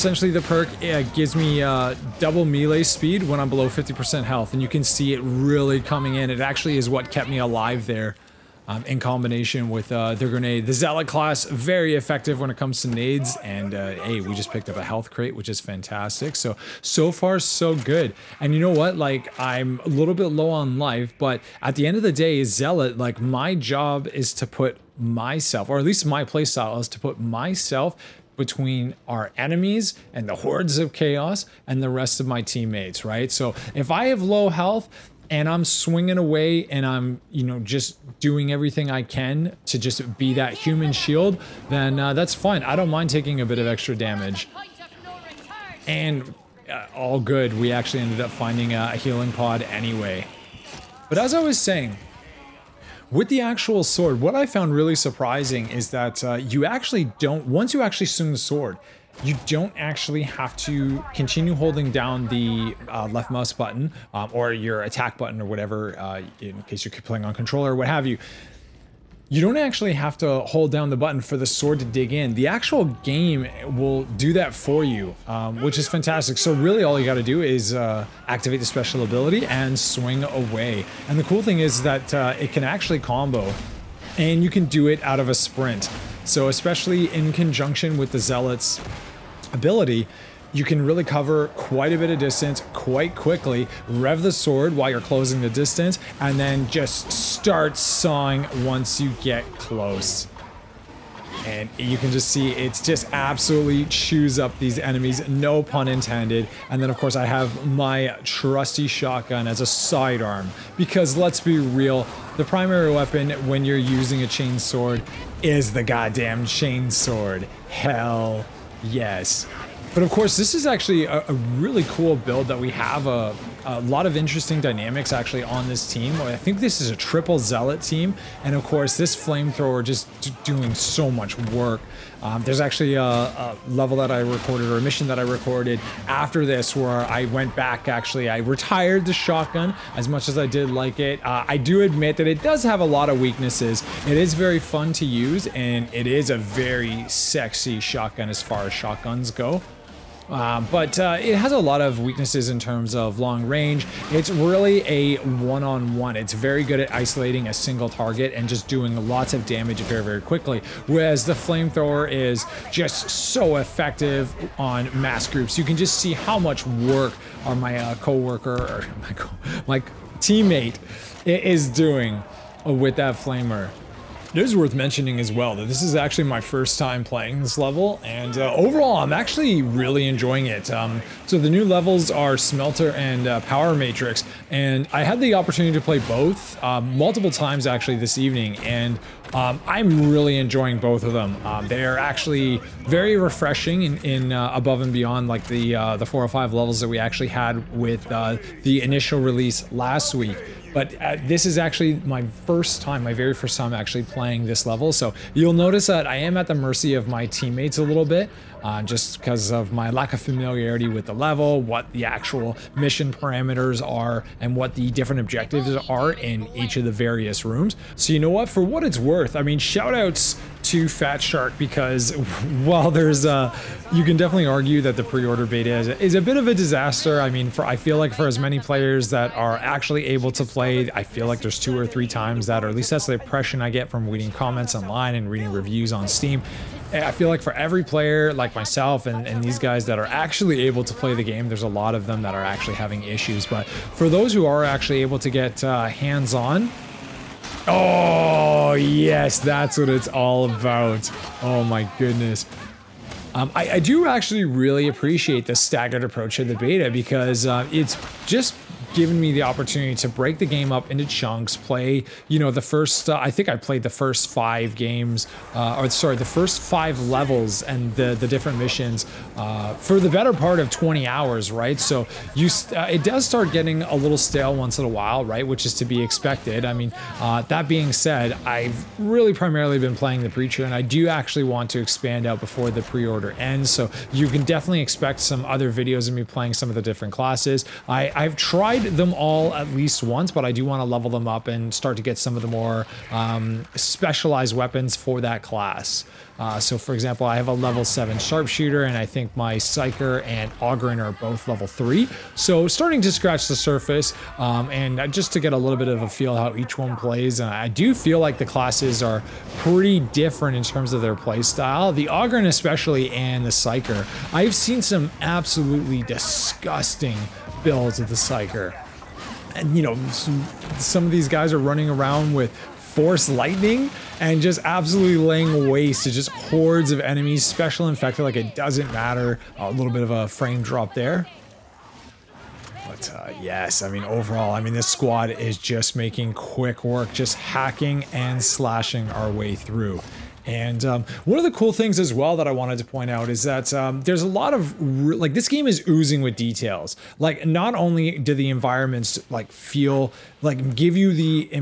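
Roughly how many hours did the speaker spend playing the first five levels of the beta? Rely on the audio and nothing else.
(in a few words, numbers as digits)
20.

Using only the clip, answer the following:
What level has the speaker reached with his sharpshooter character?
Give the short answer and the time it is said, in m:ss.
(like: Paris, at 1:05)
7, at 4:57.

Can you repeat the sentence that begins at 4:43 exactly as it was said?
So you can definitely expect some other videos of me playing some of the different classes.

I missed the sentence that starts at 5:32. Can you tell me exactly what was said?
But uh, yes, I mean, overall, I mean, this squad is just making quick work, just hacking and slashing our way through.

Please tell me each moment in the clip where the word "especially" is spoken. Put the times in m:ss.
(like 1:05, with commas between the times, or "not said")
1:26, 5:12.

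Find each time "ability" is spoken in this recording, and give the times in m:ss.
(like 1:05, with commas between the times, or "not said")
1:19, 1:29.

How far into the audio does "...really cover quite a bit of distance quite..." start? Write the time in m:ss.
1:30.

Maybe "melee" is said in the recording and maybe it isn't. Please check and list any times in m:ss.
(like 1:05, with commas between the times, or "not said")
0:02.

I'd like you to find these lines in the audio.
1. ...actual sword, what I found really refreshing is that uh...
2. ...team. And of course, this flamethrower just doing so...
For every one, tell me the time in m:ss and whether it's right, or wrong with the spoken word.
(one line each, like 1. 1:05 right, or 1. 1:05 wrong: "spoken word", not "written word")
1. 0:53 wrong: "surprising", not "refreshing"
2. 2:07 right.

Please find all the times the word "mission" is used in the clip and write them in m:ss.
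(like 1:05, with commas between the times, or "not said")
2:14, 3:32, 4:28.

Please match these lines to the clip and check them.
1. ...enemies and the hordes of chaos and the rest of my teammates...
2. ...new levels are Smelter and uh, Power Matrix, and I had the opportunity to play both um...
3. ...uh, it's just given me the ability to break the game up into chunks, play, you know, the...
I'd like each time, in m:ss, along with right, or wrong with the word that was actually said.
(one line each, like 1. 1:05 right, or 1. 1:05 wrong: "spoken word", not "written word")
1. 0:29 right
2. 3:01 right
3. 4:17 wrong: "opportunity", not "ability".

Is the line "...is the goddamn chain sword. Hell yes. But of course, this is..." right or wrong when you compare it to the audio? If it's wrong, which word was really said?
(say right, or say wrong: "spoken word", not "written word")
right.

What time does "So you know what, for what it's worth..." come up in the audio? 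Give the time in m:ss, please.
3:37.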